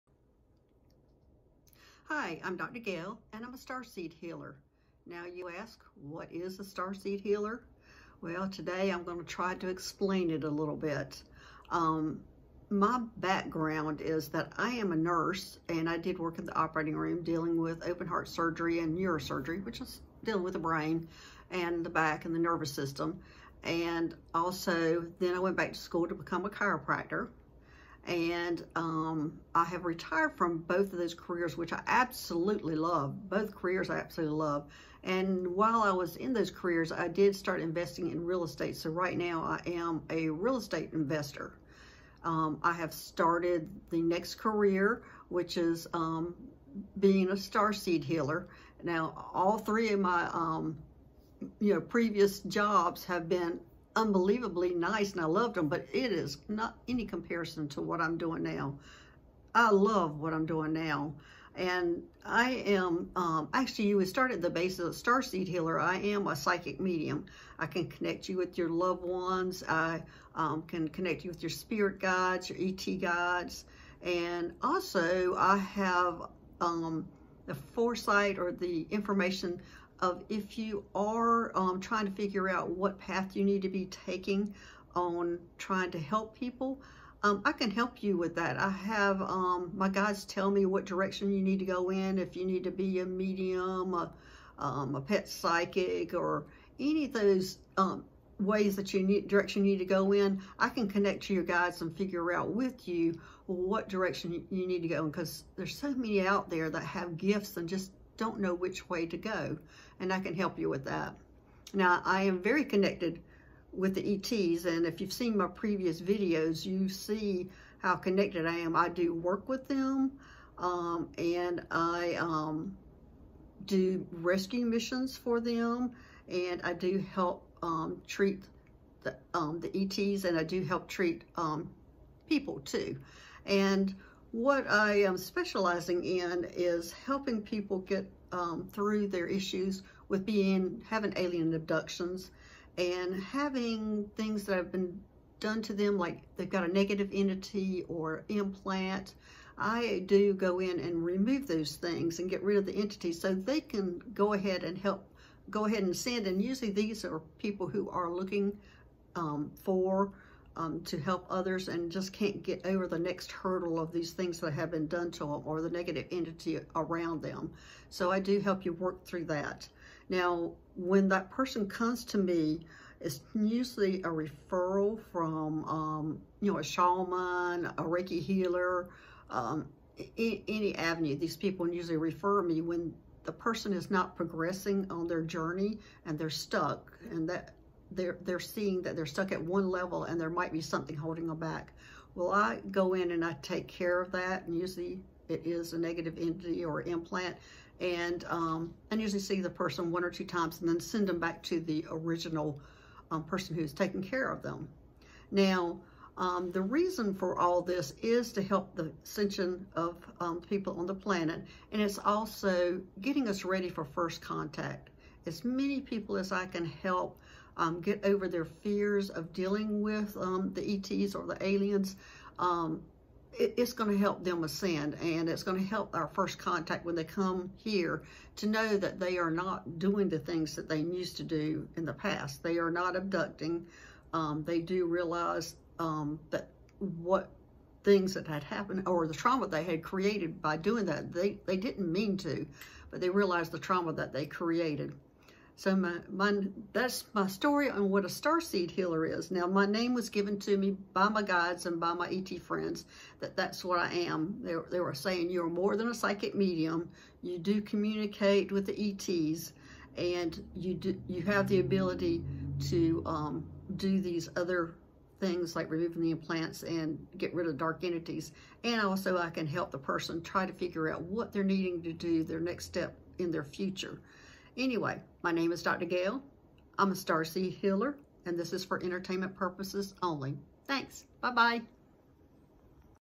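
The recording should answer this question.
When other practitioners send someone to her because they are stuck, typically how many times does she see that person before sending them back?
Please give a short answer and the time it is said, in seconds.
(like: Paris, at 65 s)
1 or 2 times, at 199 s.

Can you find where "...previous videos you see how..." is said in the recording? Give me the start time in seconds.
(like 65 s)
115 s.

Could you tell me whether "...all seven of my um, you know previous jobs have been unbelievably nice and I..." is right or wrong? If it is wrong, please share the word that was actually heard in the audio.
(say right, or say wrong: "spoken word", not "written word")
wrong: "three", not "seven".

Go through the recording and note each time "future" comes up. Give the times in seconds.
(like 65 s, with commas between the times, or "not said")
273 s.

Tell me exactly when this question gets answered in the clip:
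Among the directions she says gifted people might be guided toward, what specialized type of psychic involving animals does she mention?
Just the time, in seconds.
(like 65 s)
95 s.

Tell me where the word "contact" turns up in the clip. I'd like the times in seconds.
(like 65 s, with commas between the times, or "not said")
214 s, 226 s.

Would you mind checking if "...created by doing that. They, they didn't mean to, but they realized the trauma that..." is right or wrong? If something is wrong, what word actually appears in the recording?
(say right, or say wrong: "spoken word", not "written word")
right.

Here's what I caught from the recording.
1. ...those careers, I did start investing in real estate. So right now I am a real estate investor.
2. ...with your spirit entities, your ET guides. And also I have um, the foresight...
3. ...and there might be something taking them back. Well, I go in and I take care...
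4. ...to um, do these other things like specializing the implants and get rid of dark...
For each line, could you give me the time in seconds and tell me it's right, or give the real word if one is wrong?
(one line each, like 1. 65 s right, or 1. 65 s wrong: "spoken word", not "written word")
1. 36 s right
2. 71 s wrong: "guides", not "entities"
3. 190 s wrong: "holding", not "taking"
4. 262 s wrong: "removing", not "specializing".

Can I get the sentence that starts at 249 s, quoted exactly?
Now, my name was given to me by my guides and by my ET friends that that's what I am.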